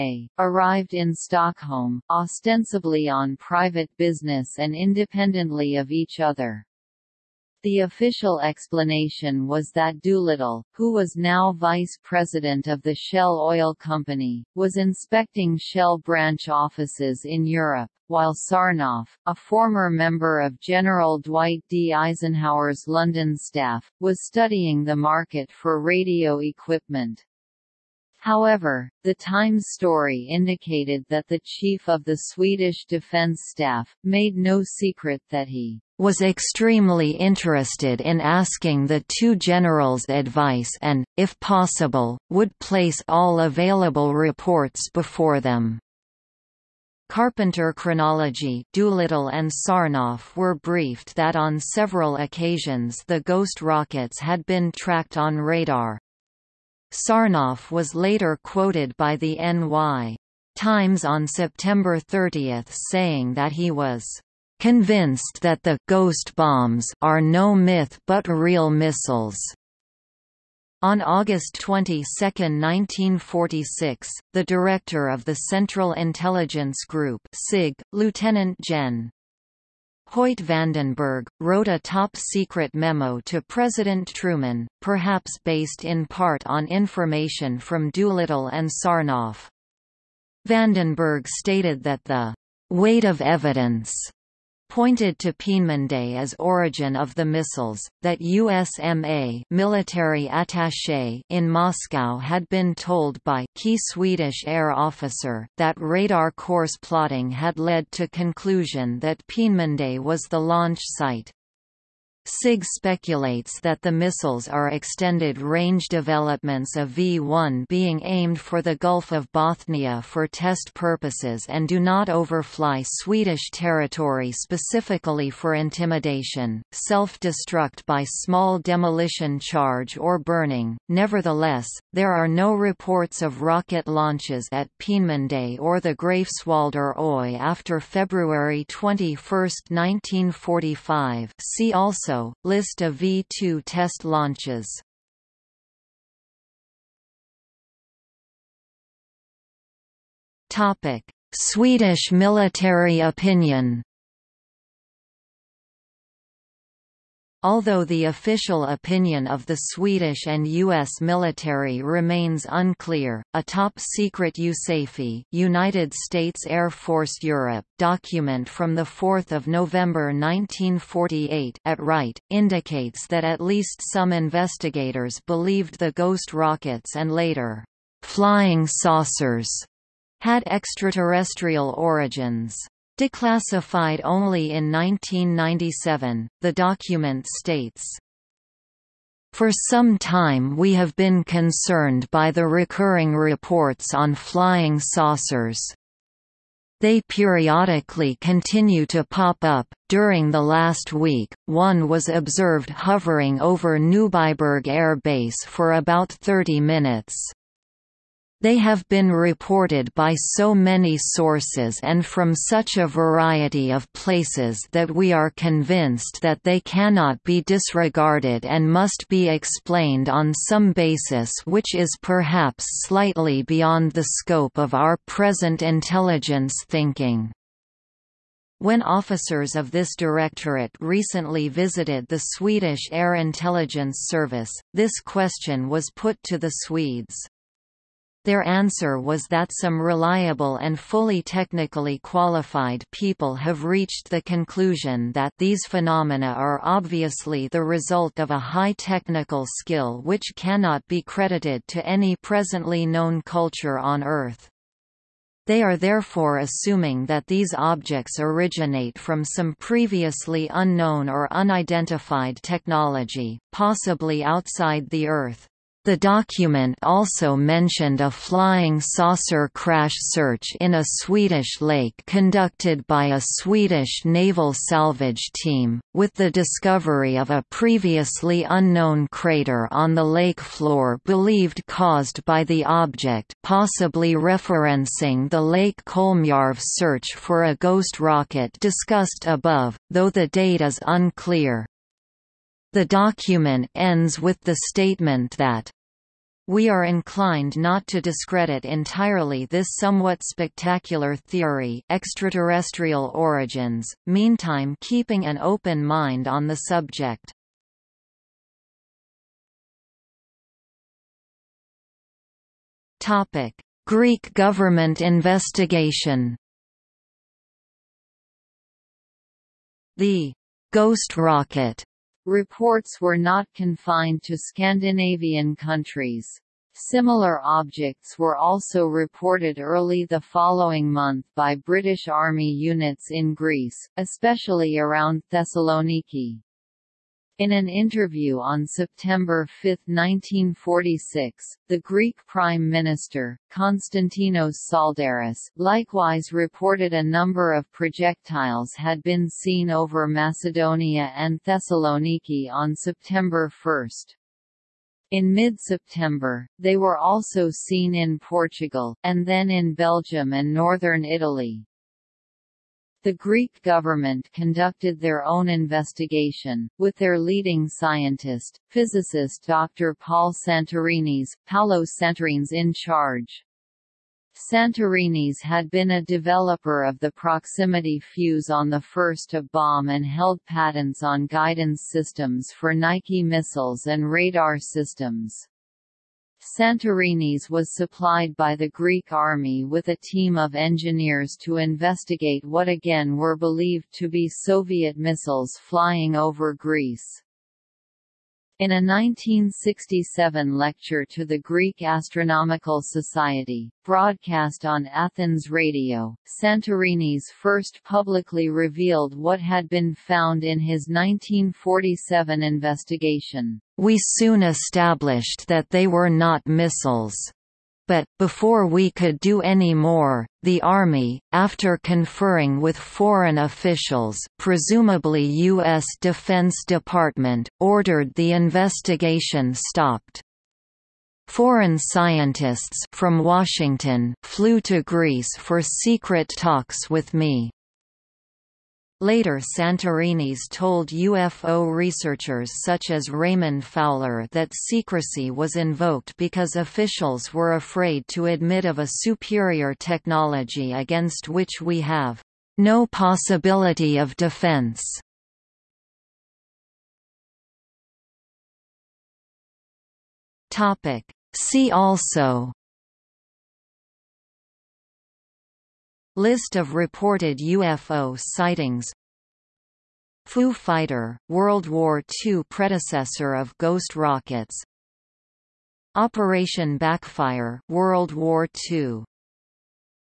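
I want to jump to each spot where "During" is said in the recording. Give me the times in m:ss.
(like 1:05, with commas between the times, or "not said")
3:19.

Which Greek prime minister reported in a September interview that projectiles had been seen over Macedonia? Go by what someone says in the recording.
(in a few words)
Konstantinos Tsaldaris.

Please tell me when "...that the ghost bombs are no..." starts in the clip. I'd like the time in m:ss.
1:05.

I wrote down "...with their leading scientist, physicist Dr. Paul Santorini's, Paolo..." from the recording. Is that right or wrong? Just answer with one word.
right.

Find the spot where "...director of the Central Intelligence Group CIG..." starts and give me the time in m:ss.
1:14.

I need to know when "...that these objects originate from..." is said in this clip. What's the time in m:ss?
4:17.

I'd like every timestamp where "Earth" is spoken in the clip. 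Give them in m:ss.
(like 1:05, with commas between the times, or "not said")
4:14, 4:25.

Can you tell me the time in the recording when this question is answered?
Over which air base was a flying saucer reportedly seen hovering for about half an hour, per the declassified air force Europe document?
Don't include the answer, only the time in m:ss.
3:23.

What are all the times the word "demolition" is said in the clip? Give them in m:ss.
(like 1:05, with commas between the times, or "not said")
2:08.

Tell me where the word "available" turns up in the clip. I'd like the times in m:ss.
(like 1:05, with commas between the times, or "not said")
0:43.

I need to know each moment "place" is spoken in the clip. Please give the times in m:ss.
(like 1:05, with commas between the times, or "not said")
0:42, 3:33.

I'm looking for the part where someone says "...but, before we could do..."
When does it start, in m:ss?
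6:57.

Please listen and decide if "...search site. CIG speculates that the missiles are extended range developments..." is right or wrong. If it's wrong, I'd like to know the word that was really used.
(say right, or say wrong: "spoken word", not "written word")
wrong: "launch", not "search".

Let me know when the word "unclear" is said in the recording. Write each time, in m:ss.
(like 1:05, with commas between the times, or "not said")
2:42, 4:50.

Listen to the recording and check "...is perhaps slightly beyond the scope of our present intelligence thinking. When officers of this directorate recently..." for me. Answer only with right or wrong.
right.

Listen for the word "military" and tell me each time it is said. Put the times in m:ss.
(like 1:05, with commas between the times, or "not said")
1:39, 2:32, 2:40.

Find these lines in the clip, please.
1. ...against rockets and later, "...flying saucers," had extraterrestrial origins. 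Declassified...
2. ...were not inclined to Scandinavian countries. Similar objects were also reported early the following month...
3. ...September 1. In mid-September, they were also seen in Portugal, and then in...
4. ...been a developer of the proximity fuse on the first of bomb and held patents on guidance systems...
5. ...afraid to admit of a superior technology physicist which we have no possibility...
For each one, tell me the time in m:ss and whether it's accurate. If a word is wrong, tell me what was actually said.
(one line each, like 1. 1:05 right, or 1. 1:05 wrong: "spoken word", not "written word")
1. 2:55 wrong: "ghost", not "against"
2. 5:22 wrong: "confined", not "inclined"
3. 5:52 right
4. 6:15 right
5. 7:27 wrong: "against", not "physicist".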